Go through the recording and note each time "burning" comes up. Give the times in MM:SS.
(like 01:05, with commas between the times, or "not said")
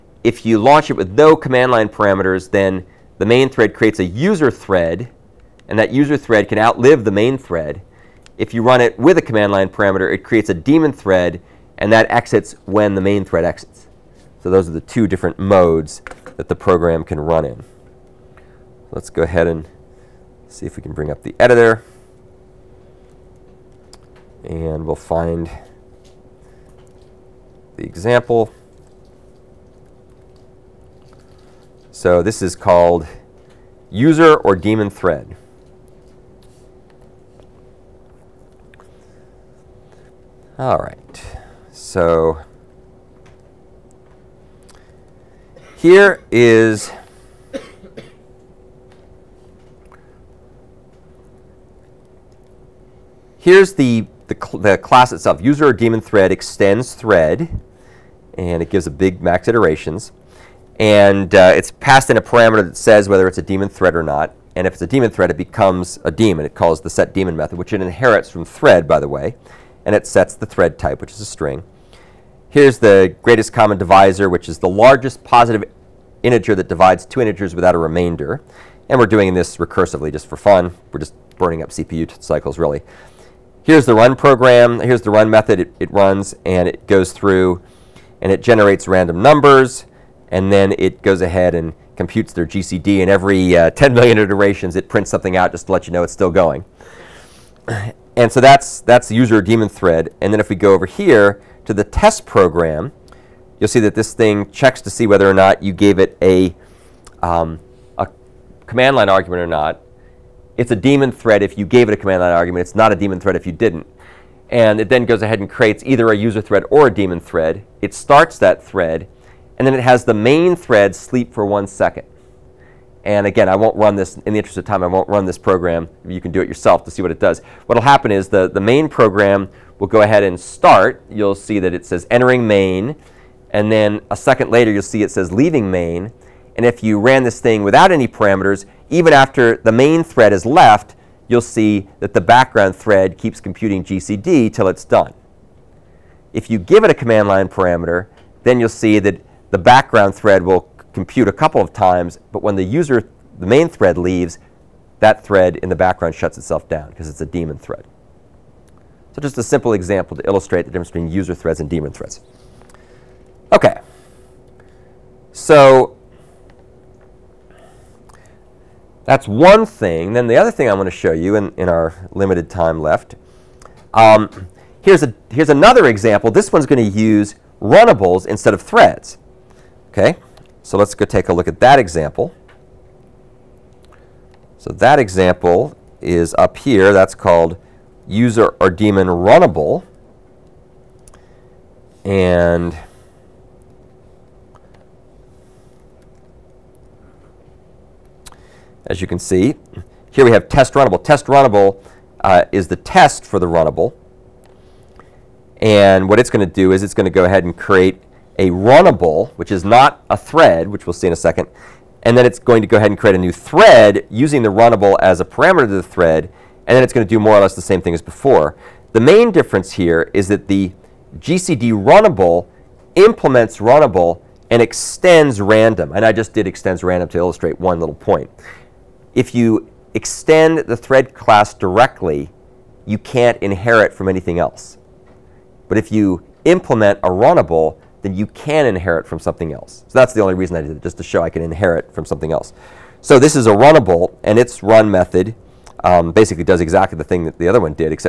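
01:21.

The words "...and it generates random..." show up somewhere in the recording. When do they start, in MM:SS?
01:28.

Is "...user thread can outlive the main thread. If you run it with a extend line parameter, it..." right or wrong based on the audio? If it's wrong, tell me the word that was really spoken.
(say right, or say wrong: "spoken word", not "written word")
wrong: "command", not "extend".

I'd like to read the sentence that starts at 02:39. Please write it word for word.
So just a simple example to illustrate the difference between user threads and daemon threads.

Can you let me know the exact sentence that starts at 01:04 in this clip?
And if it's a daemon thread, it becomes a daemon.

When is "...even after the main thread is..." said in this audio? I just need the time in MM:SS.
02:18.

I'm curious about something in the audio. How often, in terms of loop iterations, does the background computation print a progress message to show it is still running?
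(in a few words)
10 million iterations.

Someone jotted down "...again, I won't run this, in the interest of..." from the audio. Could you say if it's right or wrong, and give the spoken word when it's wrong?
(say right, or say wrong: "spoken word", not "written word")
right.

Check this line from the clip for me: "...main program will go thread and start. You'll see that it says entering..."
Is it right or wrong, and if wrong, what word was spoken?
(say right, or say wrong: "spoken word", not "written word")
wrong: "ahead", not "thread".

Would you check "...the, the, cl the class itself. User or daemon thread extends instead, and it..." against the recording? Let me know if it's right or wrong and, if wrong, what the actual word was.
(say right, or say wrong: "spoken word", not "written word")
wrong: "thread", not "instead".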